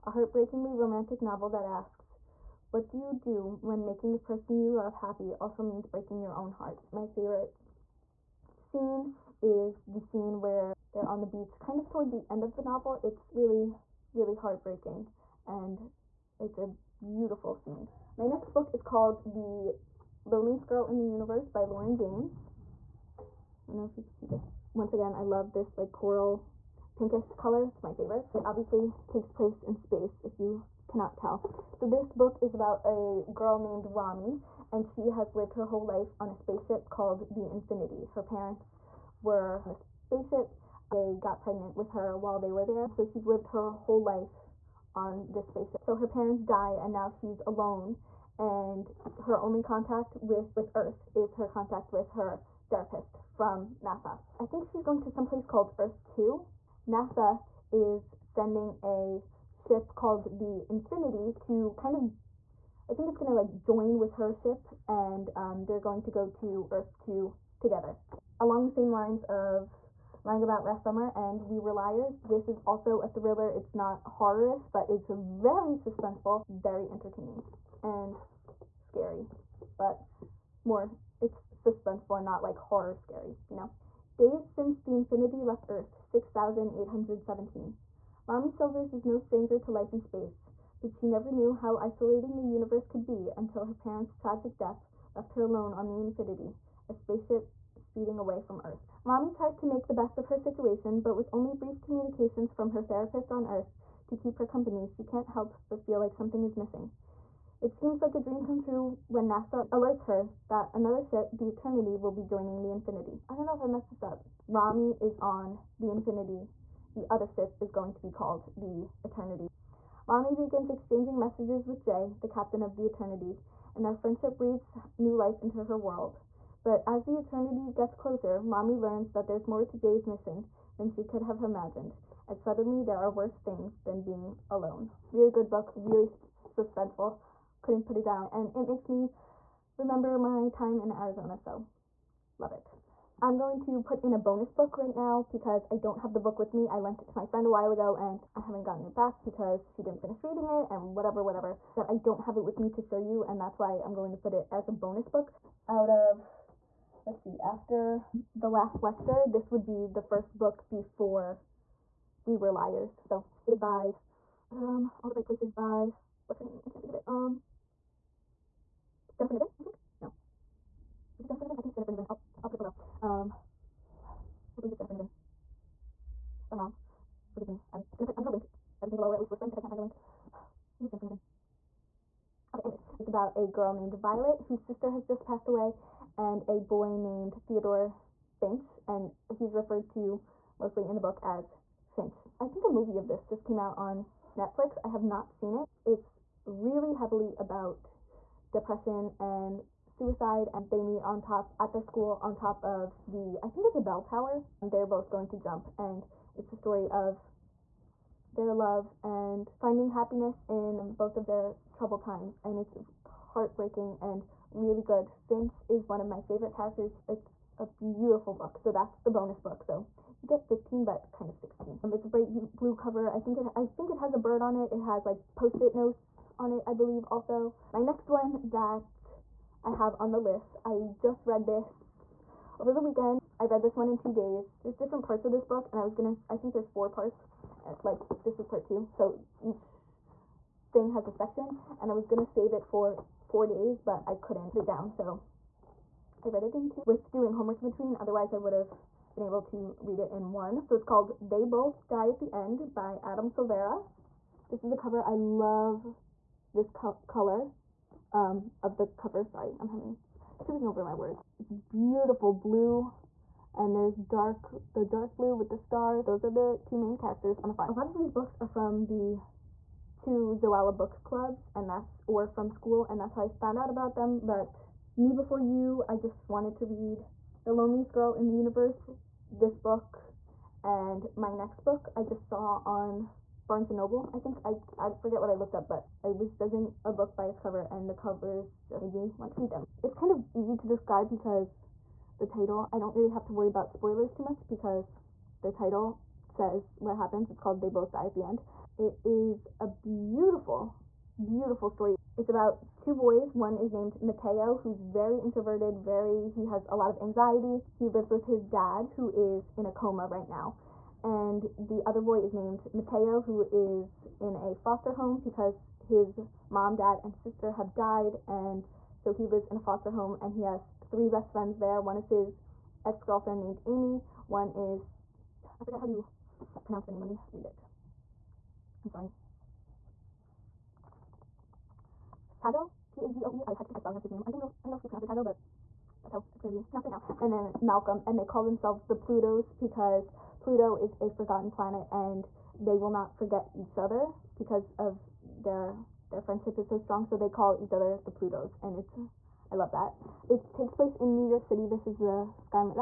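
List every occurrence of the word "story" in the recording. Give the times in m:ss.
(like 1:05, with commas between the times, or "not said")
3:26, 5:01.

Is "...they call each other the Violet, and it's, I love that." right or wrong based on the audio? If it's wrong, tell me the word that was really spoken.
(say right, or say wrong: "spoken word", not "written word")
wrong: "Plutos", not "Violet".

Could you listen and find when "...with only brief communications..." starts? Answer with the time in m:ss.
1:41.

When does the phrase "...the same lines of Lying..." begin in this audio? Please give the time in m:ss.
1:08.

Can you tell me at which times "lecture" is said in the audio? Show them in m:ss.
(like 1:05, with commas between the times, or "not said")
2:38.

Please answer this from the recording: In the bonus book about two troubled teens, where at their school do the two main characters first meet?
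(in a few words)
bell tower.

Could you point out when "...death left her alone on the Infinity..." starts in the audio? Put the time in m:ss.
1:34.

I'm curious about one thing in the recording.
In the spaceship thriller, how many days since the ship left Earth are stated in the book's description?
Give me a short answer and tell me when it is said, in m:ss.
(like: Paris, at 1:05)
6,817, at 1:25.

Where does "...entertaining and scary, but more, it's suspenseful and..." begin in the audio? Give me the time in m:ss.
1:16.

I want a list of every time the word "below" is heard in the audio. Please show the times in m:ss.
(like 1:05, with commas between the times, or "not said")
2:52, 2:58.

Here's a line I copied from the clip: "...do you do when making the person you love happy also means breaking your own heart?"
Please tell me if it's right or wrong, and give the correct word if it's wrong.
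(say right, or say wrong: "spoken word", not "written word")
right.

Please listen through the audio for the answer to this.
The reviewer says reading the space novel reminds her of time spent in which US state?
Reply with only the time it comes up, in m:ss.
2:20.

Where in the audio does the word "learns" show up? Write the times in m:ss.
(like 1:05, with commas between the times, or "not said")
2:08.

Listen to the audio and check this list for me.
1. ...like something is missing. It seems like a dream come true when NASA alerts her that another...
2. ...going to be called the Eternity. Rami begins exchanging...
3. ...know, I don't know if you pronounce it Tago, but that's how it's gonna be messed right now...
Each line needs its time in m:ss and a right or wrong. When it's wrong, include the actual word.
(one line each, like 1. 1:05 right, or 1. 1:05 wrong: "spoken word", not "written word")
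1. 1:45 right
2. 1:57 right
3. 5:34 wrong: "pronounced", not "messed".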